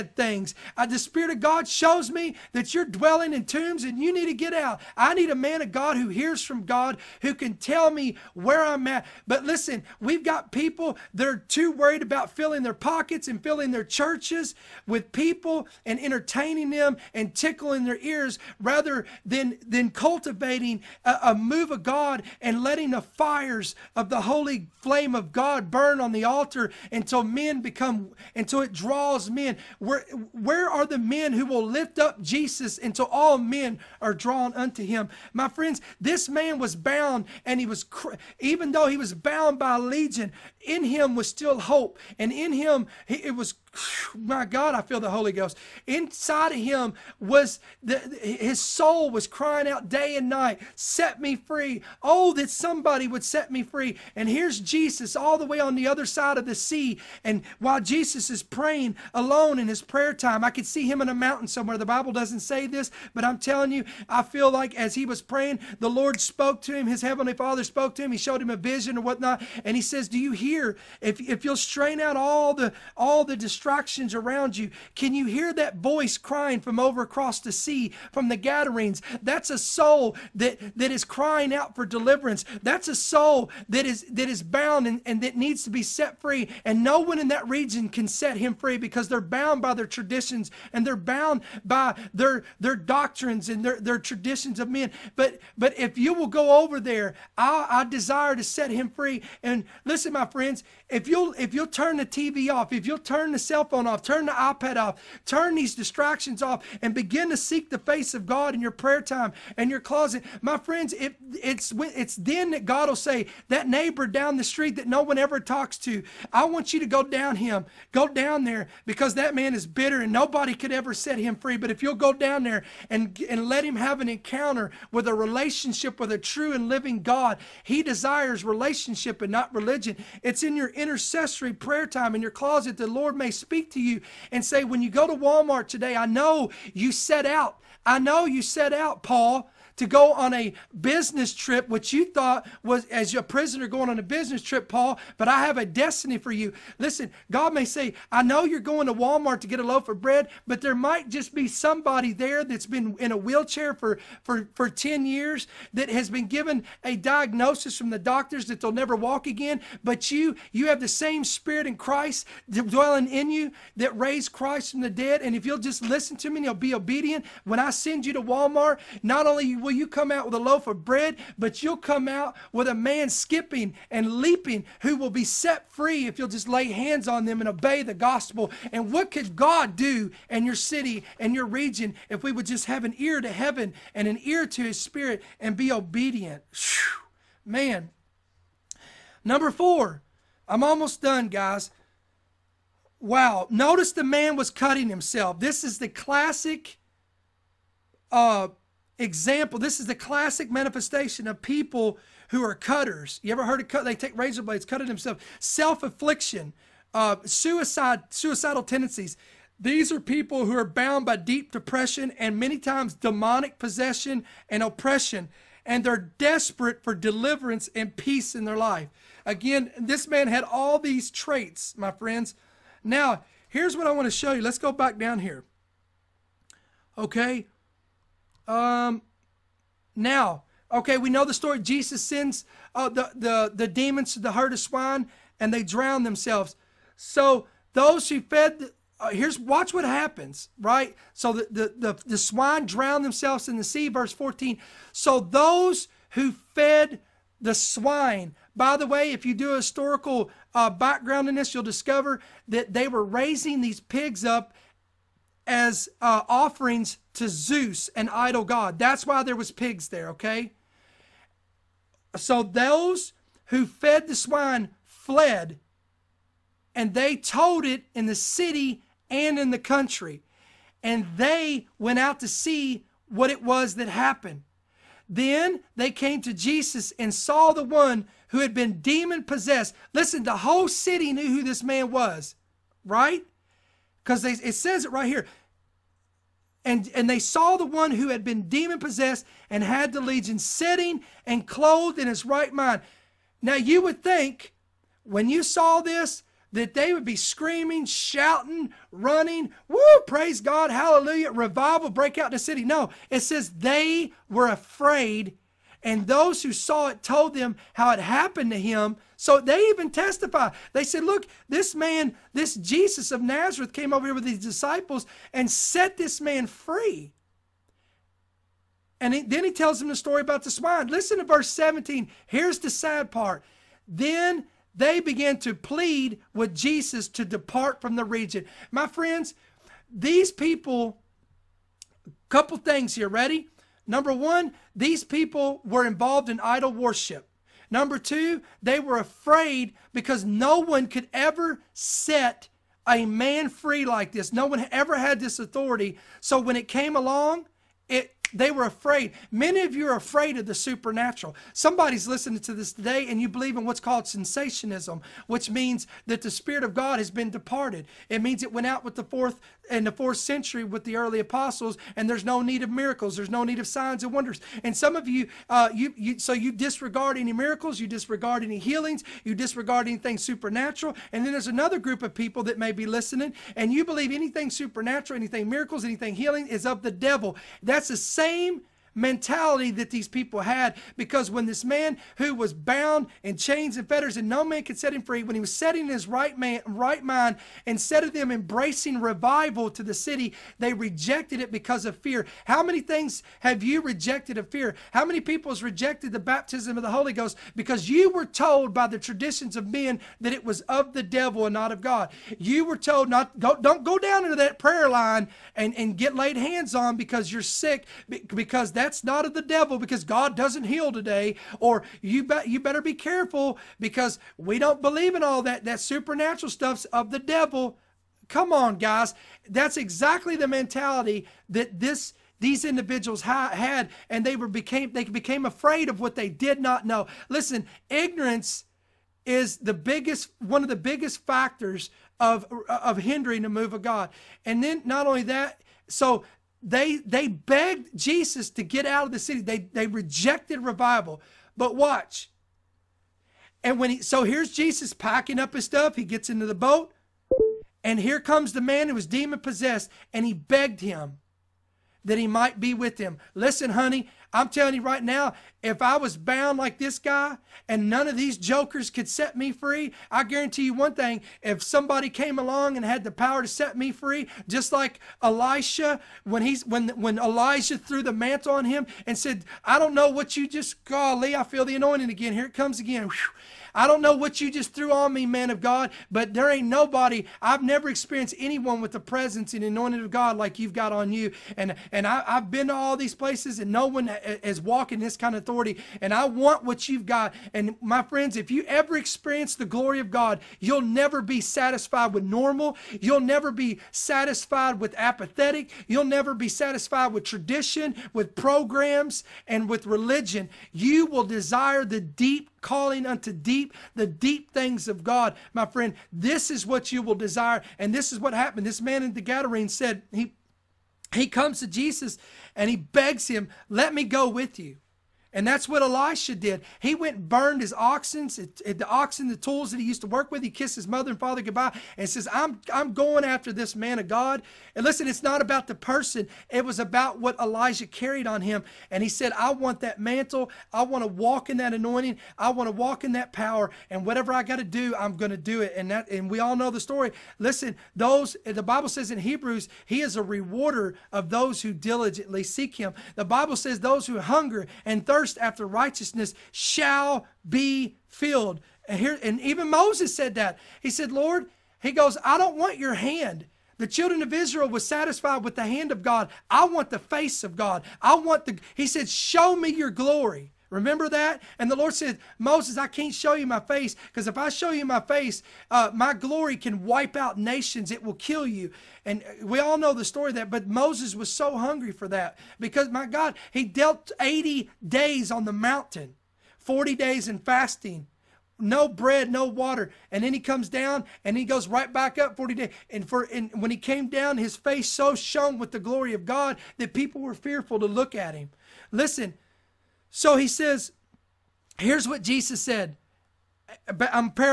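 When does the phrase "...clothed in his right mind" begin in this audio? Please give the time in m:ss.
4:51.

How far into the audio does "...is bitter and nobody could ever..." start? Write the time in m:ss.
1:59.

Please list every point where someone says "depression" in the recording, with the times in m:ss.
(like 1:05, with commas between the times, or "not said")
3:31.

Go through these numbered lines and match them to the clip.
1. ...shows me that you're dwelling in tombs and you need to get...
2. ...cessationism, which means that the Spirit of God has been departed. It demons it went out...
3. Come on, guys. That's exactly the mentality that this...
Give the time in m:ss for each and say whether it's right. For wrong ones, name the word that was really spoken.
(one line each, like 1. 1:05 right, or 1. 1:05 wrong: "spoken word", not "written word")
1. 0:01 right
2. 5:54 wrong: "means", not "demons"
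3. 6:58 right.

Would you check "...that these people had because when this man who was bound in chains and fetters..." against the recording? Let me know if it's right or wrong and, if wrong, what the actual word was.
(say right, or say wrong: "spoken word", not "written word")
right.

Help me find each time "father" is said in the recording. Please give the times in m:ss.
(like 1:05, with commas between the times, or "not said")
1:07, 8:41.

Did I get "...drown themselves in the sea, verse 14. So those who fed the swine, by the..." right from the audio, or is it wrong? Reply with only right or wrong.
right.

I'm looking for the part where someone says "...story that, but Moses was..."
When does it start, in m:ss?
9:30.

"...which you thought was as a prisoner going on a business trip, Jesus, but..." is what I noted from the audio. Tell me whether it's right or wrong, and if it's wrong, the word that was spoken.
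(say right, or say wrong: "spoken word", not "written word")
wrong: "Paul", not "Jesus".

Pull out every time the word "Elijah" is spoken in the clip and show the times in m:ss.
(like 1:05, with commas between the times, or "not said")
7:47, 8:47.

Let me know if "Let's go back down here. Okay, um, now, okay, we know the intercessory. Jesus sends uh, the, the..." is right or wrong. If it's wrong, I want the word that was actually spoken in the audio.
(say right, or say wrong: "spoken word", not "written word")
wrong: "story", not "intercessory".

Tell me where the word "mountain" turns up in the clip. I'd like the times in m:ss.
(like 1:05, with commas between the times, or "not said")
1:01, 9:35.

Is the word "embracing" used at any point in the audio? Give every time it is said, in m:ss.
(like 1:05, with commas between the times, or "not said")
6:28.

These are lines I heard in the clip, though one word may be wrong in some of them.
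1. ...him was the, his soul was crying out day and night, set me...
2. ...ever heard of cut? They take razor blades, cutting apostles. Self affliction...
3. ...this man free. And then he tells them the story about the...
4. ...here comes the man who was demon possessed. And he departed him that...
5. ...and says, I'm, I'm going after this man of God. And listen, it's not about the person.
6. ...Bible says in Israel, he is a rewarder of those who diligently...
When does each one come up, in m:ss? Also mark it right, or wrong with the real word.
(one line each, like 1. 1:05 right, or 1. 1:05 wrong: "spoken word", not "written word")
1. 0:46 right
2. 3:23 wrong: "themselves", not "apostles"
3. 5:15 right
4. 7:27 wrong: "begged", not "departed"
5. 8:41 right
6. 8:58 wrong: "Hebrews", not "Israel".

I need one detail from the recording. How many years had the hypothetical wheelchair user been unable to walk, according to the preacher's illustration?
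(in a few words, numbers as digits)
10.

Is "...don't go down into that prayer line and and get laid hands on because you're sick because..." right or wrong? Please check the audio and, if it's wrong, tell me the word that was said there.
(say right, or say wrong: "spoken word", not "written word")
right.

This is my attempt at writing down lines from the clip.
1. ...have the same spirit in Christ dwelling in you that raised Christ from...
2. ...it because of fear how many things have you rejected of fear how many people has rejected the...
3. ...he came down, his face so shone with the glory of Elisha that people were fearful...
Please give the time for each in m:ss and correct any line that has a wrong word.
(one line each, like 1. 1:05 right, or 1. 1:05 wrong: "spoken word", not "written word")
1. 2:40 right
2. 6:31 right
3. 9:43 wrong: "God", not "Elisha".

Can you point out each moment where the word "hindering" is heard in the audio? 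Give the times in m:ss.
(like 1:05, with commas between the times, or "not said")
7:12.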